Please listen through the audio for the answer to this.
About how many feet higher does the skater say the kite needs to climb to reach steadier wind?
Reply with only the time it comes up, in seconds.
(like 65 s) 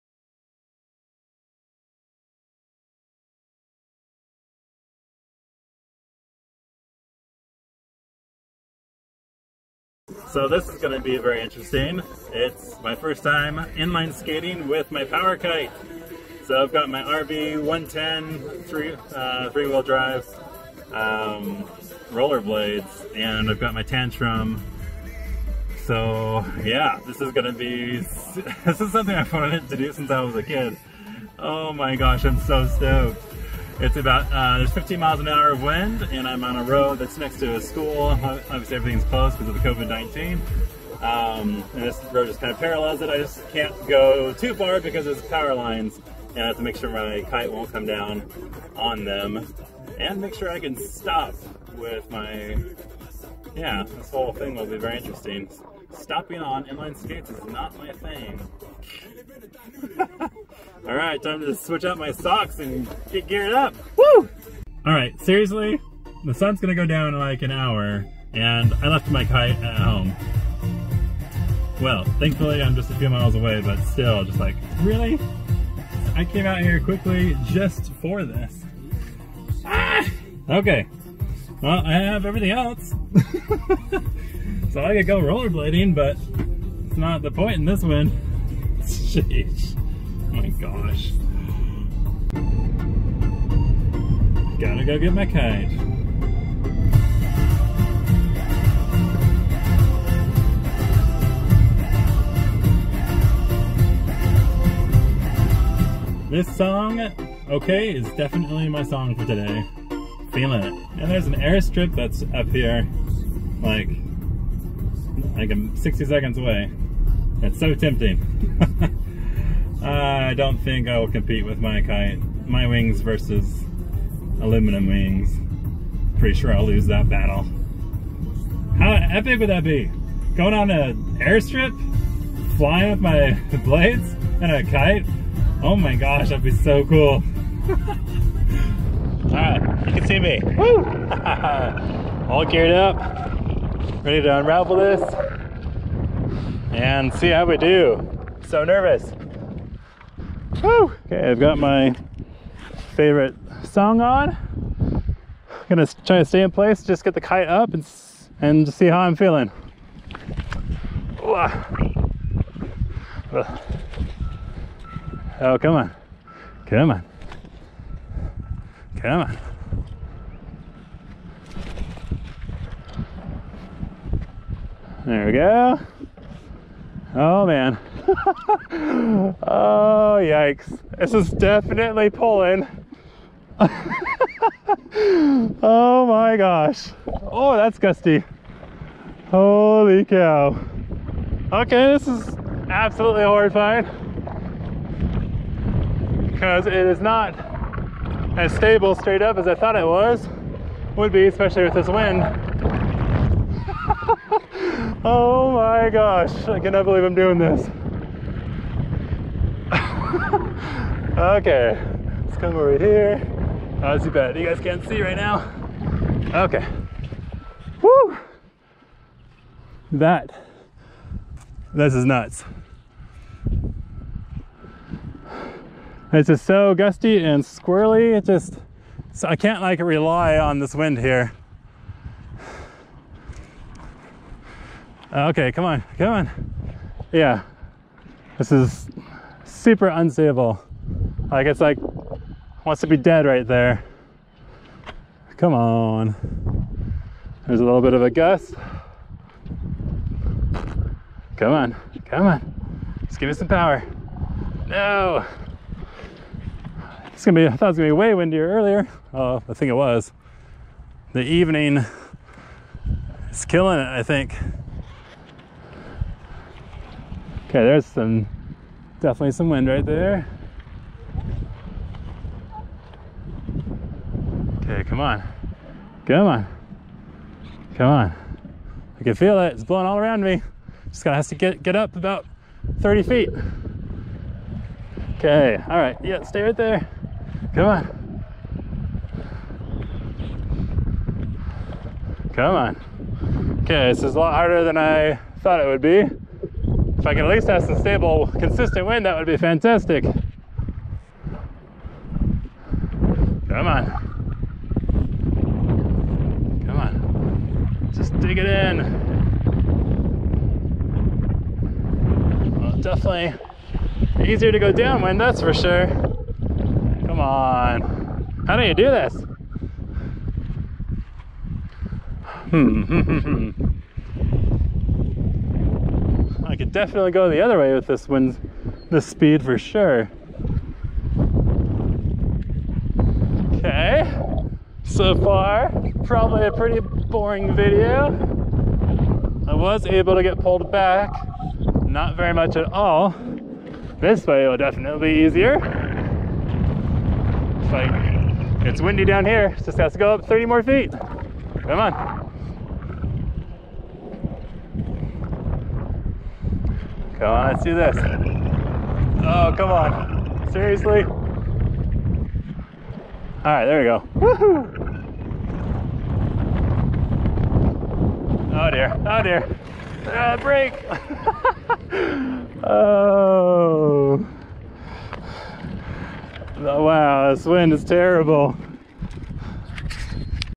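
282 s.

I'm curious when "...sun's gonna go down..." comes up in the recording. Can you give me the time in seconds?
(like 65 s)
66 s.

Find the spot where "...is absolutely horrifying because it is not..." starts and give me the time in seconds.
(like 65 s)
192 s.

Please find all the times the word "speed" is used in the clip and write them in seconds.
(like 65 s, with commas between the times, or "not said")
329 s.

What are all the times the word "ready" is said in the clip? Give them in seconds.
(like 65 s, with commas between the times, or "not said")
144 s.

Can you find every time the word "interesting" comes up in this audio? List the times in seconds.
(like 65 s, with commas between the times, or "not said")
11 s, 54 s.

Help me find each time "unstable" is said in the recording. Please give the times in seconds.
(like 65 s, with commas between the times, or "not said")
239 s.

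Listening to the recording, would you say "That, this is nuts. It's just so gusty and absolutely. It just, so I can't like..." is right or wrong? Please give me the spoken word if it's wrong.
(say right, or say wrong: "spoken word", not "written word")
wrong: "squirrely", not "absolutely".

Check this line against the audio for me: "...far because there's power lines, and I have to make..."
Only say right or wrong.
right.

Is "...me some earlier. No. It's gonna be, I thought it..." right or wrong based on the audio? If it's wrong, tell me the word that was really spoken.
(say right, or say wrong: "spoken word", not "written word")
wrong: "power", not "earlier".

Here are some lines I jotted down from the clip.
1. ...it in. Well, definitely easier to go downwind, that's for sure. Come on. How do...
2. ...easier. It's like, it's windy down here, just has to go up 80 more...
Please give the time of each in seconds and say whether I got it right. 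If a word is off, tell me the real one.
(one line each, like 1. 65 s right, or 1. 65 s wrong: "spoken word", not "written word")
1. 308 s right
2. 345 s wrong: "30", not "80".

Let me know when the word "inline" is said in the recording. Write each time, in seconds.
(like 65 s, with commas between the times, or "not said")
13 s, 56 s.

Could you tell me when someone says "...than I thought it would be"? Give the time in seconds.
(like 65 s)
294 s.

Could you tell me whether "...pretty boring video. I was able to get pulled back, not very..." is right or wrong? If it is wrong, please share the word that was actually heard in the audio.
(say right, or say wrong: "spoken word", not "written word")
right.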